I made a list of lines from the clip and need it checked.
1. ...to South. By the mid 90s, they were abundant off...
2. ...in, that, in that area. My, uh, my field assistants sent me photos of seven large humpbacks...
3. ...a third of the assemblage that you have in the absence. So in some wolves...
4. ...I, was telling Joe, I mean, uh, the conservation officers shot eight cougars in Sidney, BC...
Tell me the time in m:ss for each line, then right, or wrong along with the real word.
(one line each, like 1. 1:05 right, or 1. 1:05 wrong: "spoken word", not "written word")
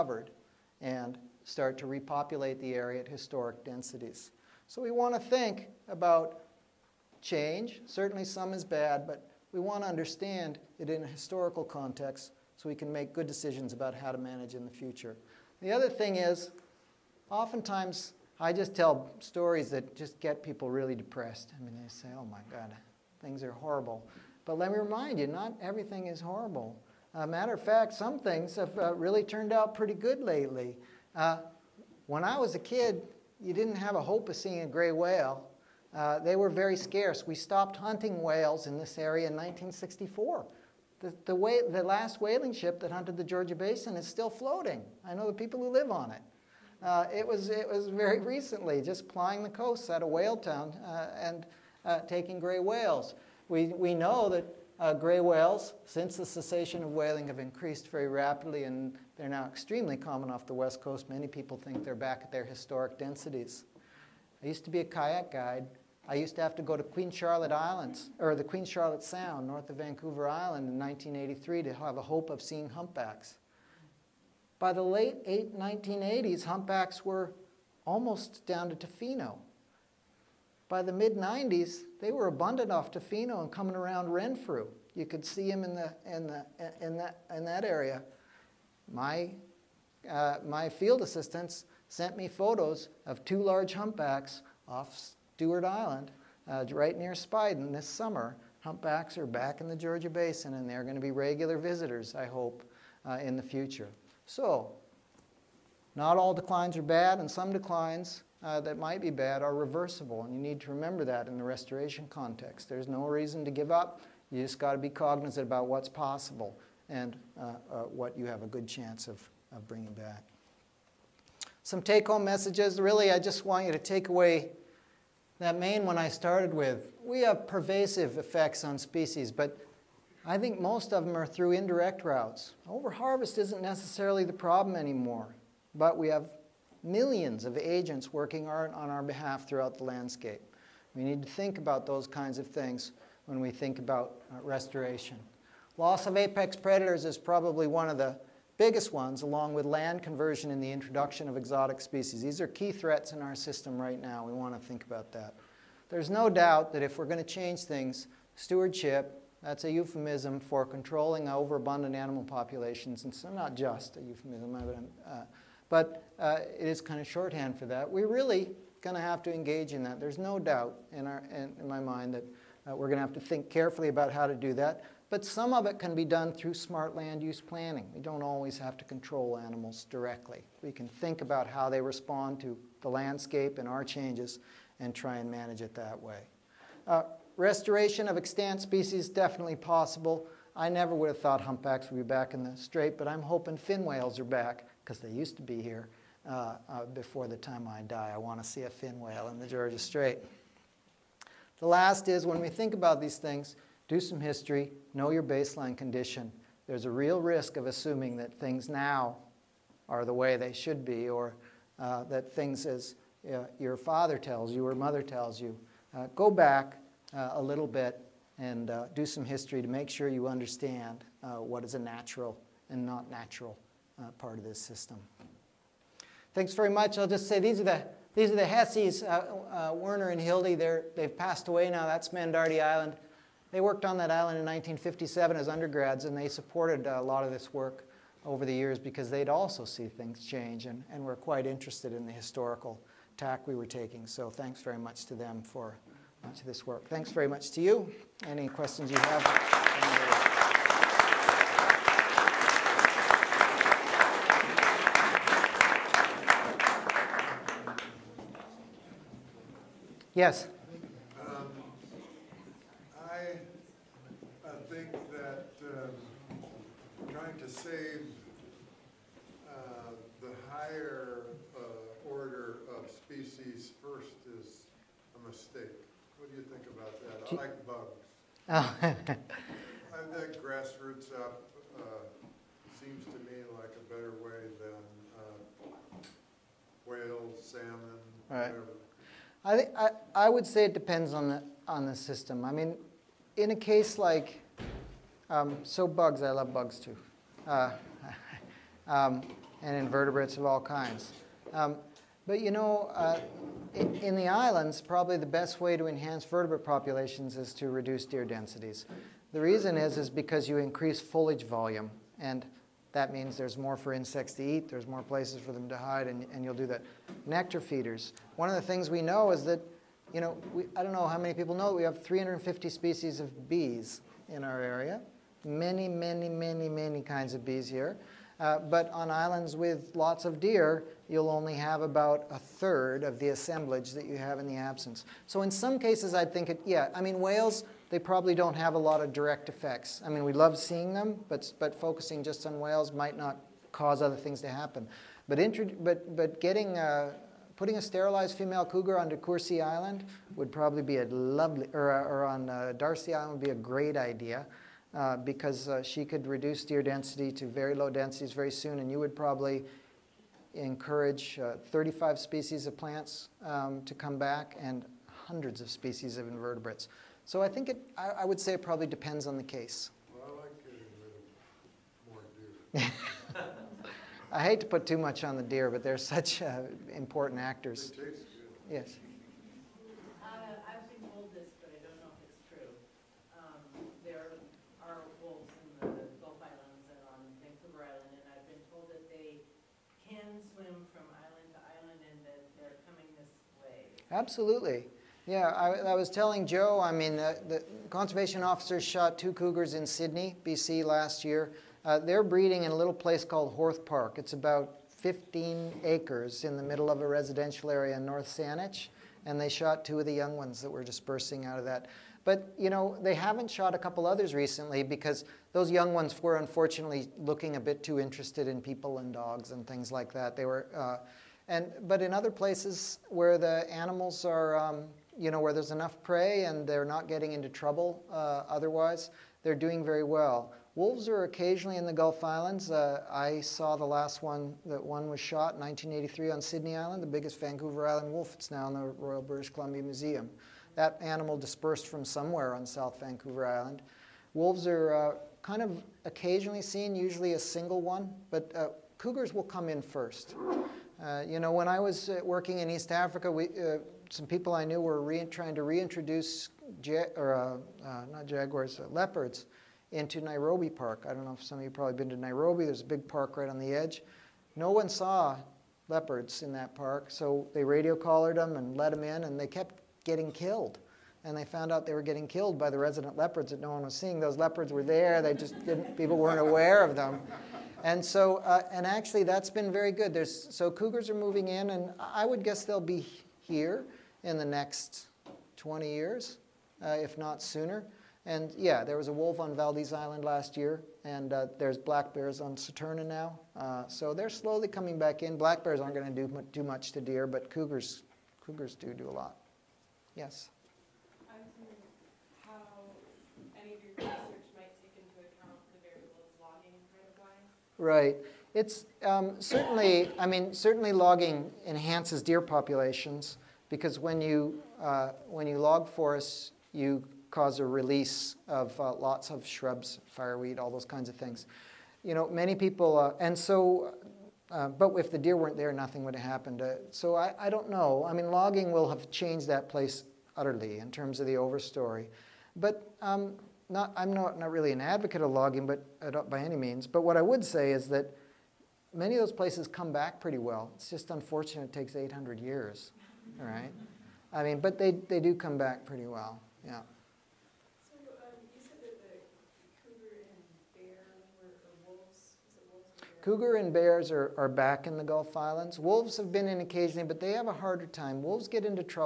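1. 1:18 wrong: "Tofino", not "South"
2. 1:26 wrong: "two", not "seven"
3. 5:32 wrong: "cases", not "wolves"
4. 6:35 wrong: "two", not "eight".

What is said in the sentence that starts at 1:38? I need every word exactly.
Humpbacks are back in the Georgia Basin, and they're going to be regular visitors, I hope, uh, in the future.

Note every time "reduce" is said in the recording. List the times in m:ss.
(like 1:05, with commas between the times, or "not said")
5:07, 5:56.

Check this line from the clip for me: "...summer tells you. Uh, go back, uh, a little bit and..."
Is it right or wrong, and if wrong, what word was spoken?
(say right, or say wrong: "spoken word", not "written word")
wrong: "mother", not "summer".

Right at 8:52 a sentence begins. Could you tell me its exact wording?
But um, not, I'm not, not really an advocate of logging but uh, by any means.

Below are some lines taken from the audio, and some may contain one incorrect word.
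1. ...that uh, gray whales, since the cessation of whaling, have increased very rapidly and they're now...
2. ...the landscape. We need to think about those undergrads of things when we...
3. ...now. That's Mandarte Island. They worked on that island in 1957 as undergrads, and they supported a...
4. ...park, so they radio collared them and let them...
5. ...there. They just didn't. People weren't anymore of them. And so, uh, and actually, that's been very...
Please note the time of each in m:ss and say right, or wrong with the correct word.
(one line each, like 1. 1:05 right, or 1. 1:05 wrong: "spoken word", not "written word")
1. 0:54 right
2. 2:19 wrong: "kinds", not "undergrads"
3. 3:51 right
4. 7:46 right
5. 7:54 wrong: "aware", not "anymore".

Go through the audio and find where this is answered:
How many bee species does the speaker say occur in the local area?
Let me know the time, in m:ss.
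5:22.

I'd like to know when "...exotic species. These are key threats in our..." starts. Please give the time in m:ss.
2:31.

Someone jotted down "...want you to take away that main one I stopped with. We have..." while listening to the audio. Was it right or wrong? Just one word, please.
wrong.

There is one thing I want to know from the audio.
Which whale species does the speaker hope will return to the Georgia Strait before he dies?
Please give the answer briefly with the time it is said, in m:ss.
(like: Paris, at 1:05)
Fin whales, at 3:13.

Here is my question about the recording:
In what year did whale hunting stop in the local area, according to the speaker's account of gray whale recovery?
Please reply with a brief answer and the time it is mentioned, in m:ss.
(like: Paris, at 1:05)
1964, at 0:39.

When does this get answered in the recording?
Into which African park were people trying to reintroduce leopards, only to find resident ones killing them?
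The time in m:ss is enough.
7:40.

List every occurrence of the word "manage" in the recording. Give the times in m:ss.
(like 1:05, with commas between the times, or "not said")
0:14, 3:05.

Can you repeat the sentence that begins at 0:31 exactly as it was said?
Uh, when I was a kid, you didn't have a hope of seeing a gray whale.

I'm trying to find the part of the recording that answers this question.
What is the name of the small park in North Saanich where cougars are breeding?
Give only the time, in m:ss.
6:43.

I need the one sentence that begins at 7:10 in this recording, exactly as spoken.
Wolves are occasionally in the Gulf Islands.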